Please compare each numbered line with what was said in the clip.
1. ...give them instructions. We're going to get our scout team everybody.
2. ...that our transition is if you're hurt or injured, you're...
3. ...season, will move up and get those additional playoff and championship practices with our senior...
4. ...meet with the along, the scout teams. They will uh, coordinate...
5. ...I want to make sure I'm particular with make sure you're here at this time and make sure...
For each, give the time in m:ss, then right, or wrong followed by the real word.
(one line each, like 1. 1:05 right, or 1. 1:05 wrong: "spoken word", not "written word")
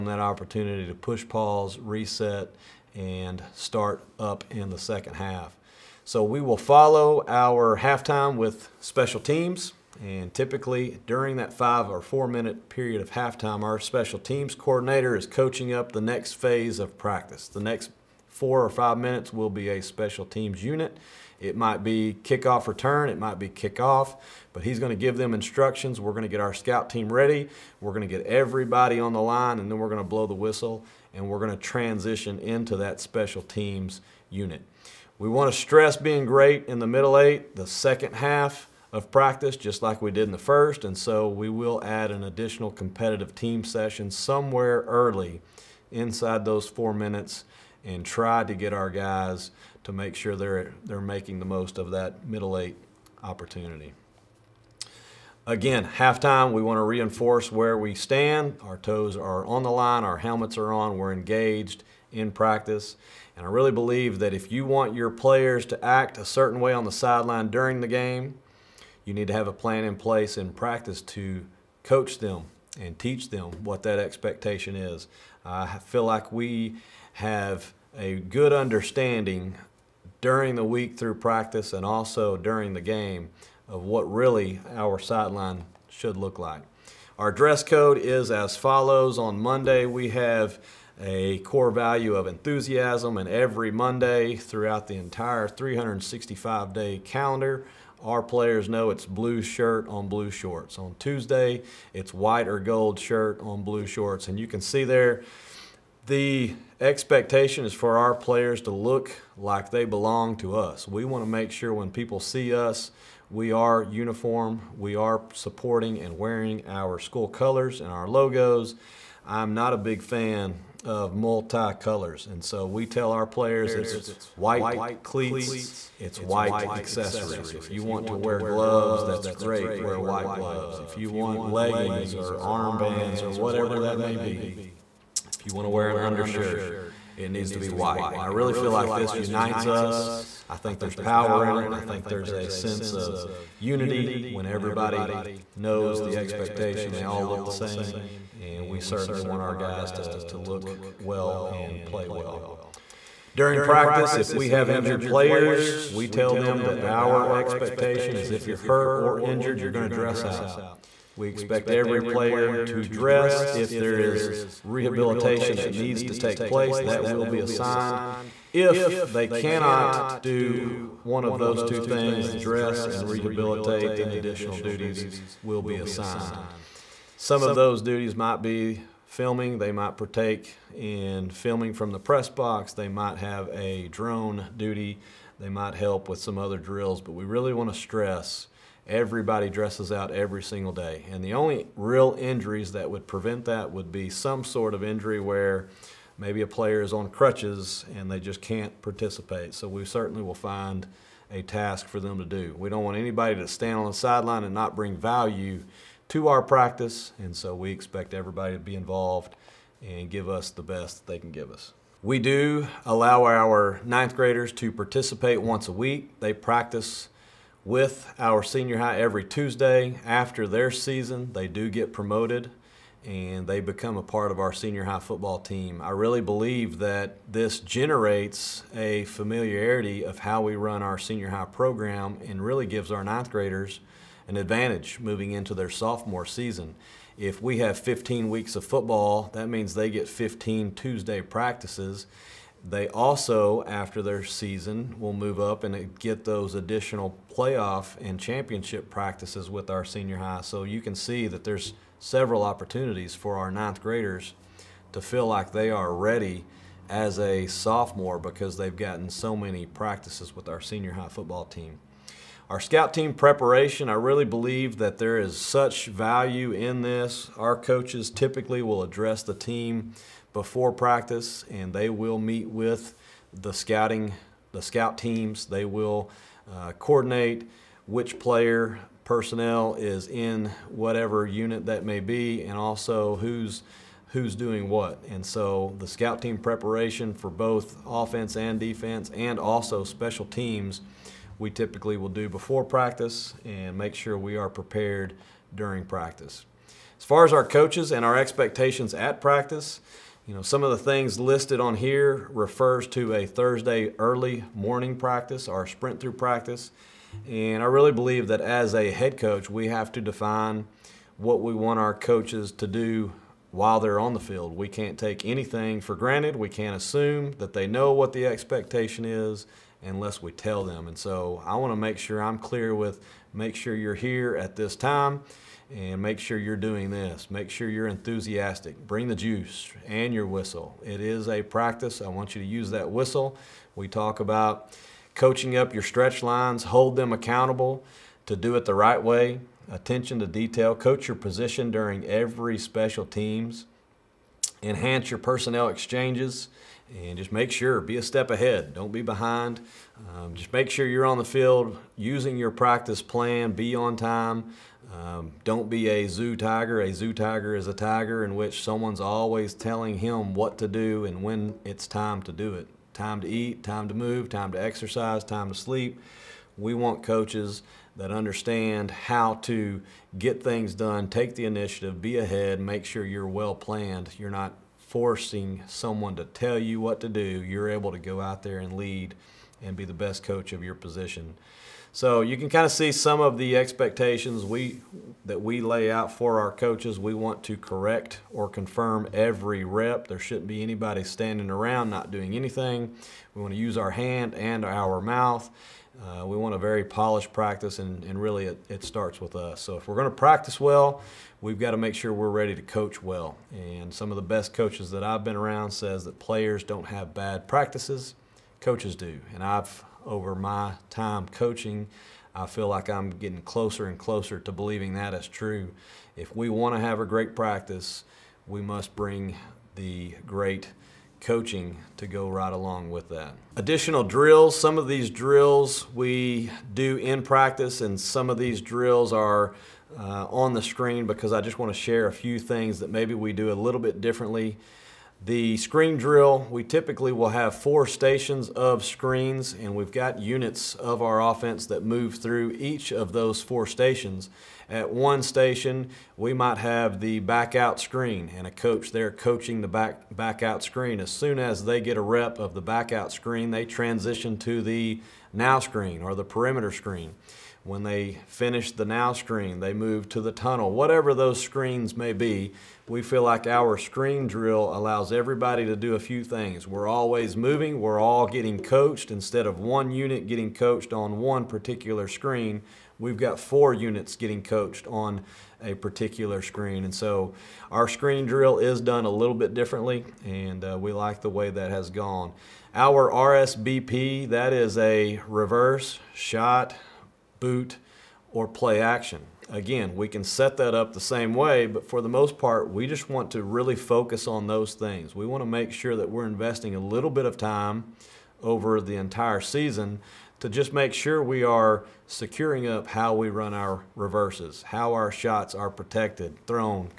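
1. 0:24 wrong: "ready", not "everybody"
2. 2:36 wrong: "expectation", not "transition"
3. 4:04 right
4. 4:32 wrong: "scouting", not "along"
5. 5:21 wrong: "clear", not "particular".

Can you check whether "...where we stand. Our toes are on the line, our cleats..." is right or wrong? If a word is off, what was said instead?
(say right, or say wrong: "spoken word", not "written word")
wrong: "helmets", not "cleats".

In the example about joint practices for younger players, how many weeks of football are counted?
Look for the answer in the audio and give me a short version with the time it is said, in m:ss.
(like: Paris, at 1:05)
15, at 3:57.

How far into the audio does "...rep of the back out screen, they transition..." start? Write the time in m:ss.
7:32.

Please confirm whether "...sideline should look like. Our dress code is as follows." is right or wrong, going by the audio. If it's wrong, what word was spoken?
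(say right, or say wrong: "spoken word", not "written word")
right.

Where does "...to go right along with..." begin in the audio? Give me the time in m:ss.
7:01.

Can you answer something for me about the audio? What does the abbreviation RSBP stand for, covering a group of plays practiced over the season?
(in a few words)
Reverse shot boot, or play action.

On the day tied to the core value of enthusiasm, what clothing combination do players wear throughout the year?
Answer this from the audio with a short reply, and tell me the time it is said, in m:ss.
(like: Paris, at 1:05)
Blue shirt on blue shorts, at 1:39.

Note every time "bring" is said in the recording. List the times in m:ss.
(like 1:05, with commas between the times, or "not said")
3:24, 5:28, 6:58.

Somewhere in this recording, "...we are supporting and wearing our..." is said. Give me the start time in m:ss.
1:54.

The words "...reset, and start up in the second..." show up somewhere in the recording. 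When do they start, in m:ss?
0:01.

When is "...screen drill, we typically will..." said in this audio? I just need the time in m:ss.
7:15.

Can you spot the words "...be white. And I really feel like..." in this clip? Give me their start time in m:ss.
2:17.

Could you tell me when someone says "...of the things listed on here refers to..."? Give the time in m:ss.
5:00.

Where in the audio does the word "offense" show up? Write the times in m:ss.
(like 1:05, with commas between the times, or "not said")
4:47, 7:21.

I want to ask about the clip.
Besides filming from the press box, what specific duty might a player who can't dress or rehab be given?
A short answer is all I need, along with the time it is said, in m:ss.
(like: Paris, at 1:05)
Drone duty, at 3:03.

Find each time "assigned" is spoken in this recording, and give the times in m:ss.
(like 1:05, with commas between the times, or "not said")
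2:47, 2:55.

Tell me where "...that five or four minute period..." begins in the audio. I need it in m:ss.
0:11.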